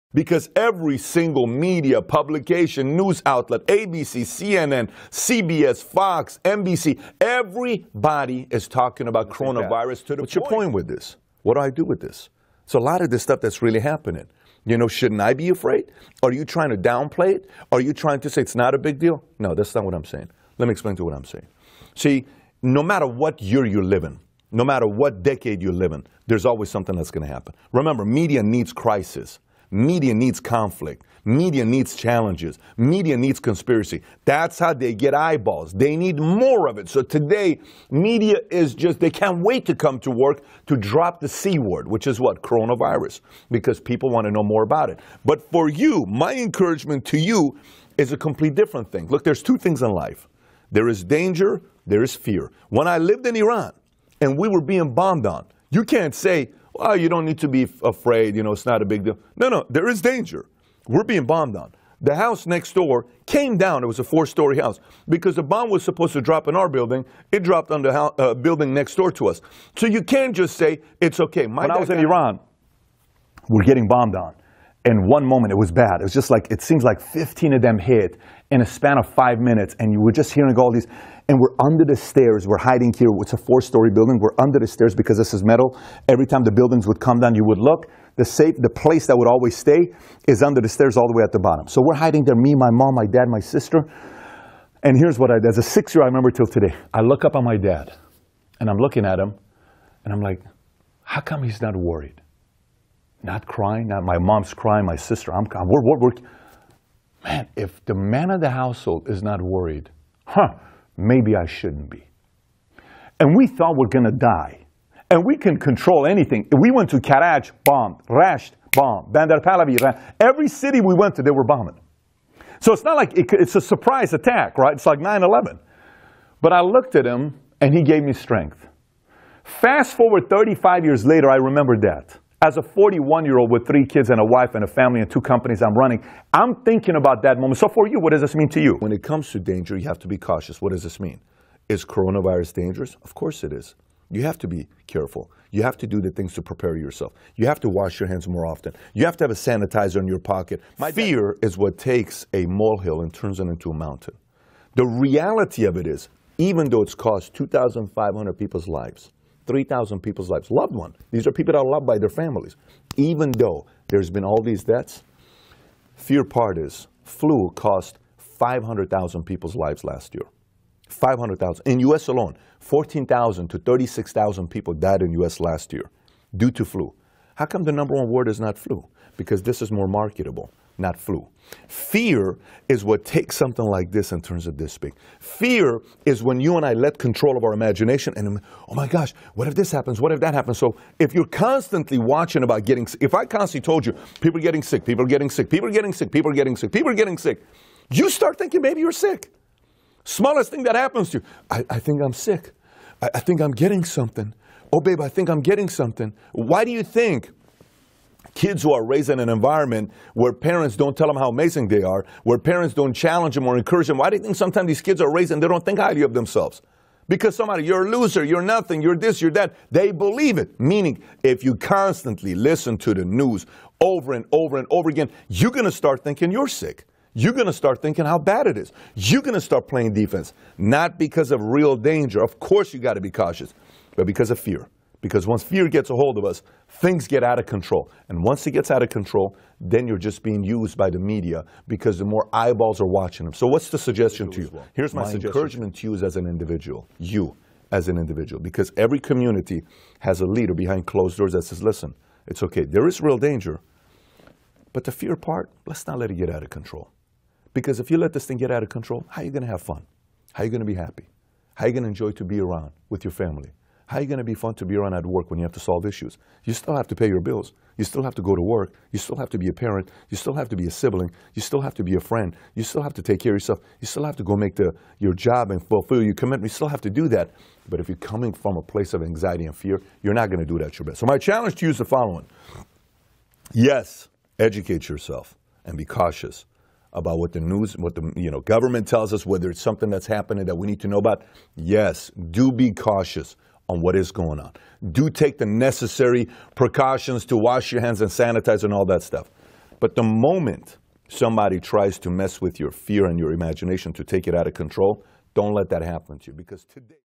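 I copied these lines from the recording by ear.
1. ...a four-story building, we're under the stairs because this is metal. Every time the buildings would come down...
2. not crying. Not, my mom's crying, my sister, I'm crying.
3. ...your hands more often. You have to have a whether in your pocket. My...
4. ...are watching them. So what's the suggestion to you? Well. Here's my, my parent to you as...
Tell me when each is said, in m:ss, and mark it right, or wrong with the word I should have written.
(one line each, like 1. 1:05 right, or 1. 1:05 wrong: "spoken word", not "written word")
1. 1:23 right
2. 1:43 right
3. 2:27 wrong: "sanitizer", not "whether"
4. 4:02 wrong: "encouragement", not "parent".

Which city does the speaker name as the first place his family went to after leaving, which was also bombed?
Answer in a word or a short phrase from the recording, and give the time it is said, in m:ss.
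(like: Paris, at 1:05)
Karaj, at 1:56.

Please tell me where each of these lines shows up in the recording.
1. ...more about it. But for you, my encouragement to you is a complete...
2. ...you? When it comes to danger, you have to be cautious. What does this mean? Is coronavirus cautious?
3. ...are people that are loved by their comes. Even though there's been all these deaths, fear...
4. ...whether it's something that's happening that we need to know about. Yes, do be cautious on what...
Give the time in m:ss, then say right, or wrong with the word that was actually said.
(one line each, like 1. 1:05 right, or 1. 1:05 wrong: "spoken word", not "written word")
1. 0:44 right
2. 2:18 wrong: "dangerous", not "cautious"
3. 2:41 wrong: "families", not "comes"
4. 4:49 right.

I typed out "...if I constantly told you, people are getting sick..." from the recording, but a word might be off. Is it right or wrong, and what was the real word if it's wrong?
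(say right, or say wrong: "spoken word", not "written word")
right.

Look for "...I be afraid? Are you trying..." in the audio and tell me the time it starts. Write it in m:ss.
0:15.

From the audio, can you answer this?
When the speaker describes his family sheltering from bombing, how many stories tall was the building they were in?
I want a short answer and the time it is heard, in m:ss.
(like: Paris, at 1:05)
4, at 1:04.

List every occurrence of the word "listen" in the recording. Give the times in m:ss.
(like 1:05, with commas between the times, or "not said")
3:42, 4:11.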